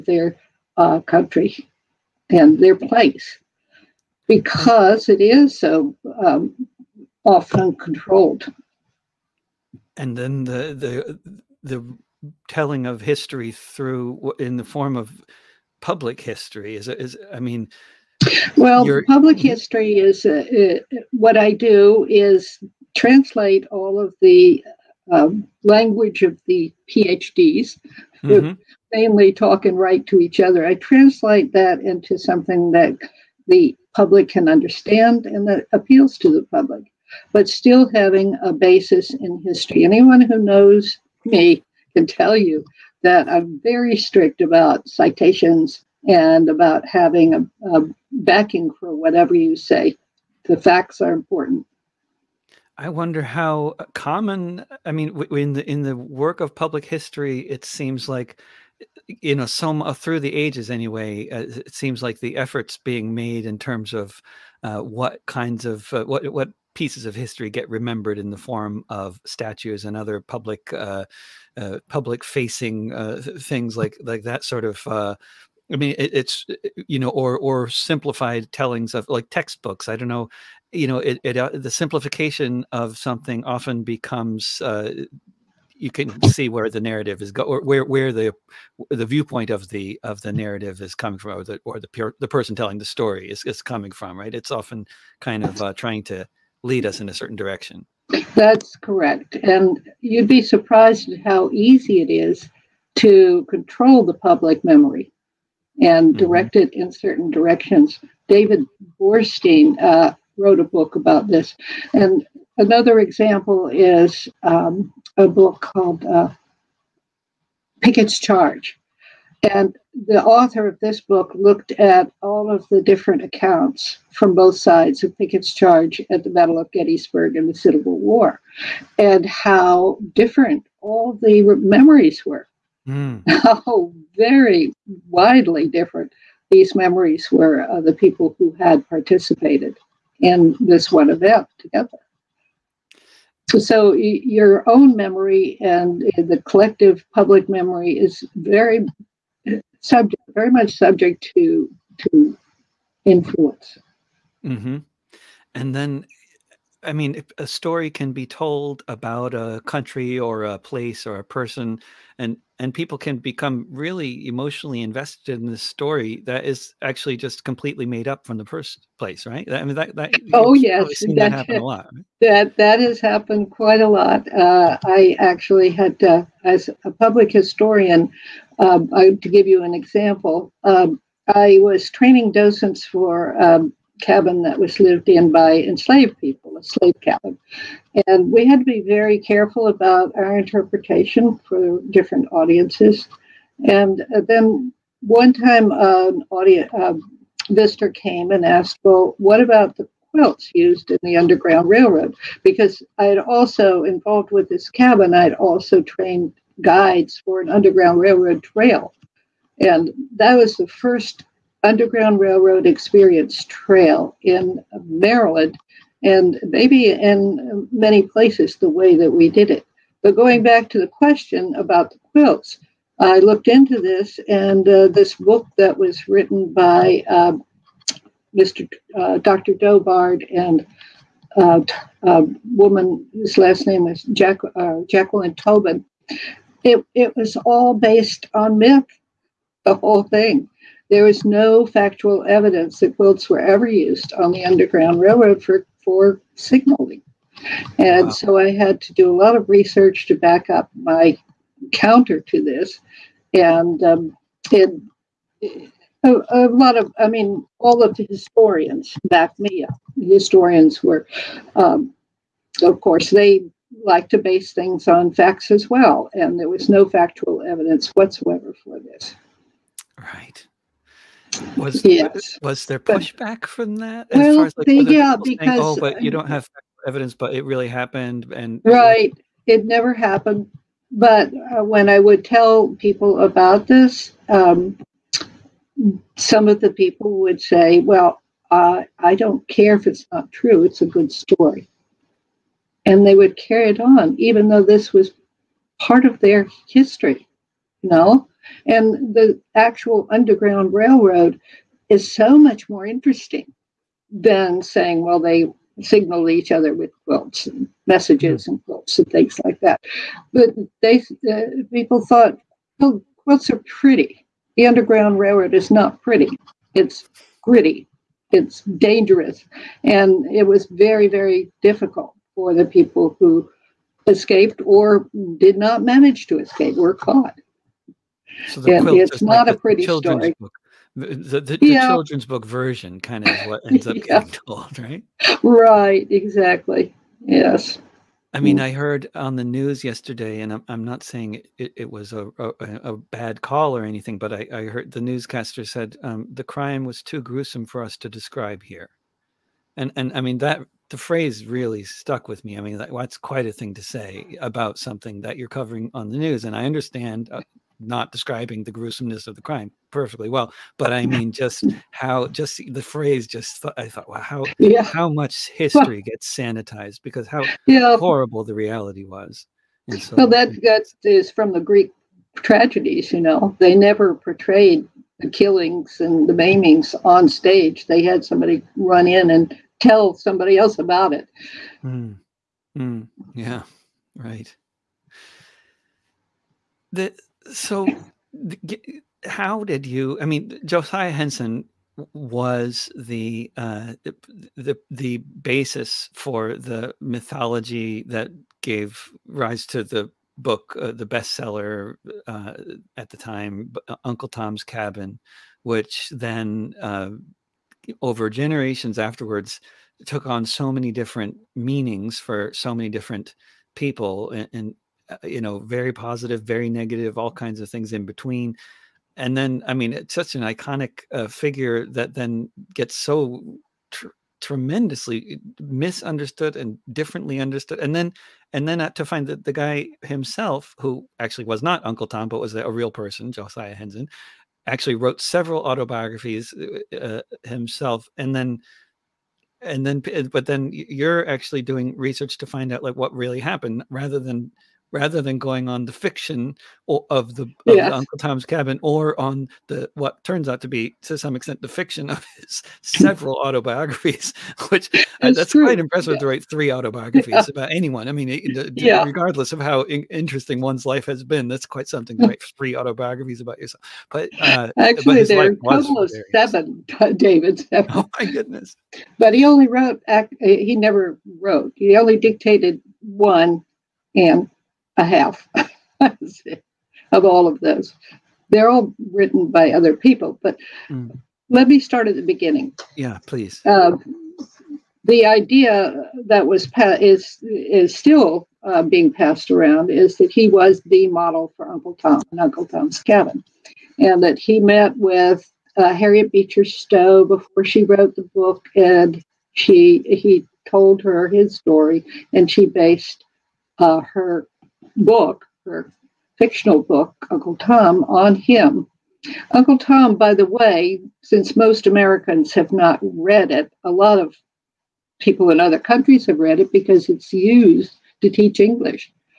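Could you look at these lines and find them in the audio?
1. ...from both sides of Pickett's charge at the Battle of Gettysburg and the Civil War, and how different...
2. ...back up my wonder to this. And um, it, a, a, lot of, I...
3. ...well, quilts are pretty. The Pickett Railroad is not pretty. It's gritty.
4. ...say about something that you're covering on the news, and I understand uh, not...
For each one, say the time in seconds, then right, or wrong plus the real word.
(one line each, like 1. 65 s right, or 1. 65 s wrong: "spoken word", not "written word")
1. 124 s right
2. 250 s wrong: "counter", not "wonder"
3. 312 s wrong: "Underground", not "Pickett"
4. 353 s right.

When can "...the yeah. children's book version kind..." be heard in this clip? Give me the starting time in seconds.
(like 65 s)
331 s.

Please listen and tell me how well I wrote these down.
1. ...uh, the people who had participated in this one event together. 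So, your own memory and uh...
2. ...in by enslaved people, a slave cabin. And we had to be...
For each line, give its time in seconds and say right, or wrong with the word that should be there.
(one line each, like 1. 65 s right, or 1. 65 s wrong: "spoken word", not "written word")
1. 137 s right
2. 185 s right.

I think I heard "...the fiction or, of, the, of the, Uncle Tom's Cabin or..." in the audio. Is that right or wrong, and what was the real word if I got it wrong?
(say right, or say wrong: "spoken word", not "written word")
right.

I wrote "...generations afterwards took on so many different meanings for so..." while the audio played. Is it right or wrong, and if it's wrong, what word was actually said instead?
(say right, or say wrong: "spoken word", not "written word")
right.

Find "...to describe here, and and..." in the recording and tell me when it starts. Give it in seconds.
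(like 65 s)
347 s.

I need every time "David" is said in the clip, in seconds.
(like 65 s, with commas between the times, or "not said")
108 s, 467 s.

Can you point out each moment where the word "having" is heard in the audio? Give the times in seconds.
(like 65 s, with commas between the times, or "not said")
37 s, 46 s.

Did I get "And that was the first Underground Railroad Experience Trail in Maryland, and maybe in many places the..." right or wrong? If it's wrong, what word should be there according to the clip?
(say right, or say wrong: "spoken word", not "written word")
right.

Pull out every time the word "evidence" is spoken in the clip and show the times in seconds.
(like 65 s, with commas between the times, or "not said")
242 s, 267 s, 276 s.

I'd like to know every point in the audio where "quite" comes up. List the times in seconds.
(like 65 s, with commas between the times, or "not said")
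173 s, 353 s, 455 s, 461 s.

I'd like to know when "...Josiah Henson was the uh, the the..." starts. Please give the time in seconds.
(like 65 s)
390 s.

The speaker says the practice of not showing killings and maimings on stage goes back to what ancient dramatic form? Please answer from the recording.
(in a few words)
Greek tragedies.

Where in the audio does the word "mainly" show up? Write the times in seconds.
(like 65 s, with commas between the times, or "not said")
28 s.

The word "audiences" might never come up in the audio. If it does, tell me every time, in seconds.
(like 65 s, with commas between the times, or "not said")
192 s, 196 s.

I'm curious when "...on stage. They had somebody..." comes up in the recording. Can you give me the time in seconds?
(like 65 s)
377 s.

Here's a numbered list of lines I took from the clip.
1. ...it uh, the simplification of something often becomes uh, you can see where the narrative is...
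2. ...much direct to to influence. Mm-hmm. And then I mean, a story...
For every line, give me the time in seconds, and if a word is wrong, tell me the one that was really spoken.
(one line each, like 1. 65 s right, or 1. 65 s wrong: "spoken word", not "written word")
1. 81 s right
2. 150 s wrong: "subject", not "direct".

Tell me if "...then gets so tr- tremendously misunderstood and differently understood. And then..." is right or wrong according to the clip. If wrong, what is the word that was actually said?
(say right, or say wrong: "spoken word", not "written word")
right.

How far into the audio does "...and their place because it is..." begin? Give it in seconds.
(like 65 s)
2 s.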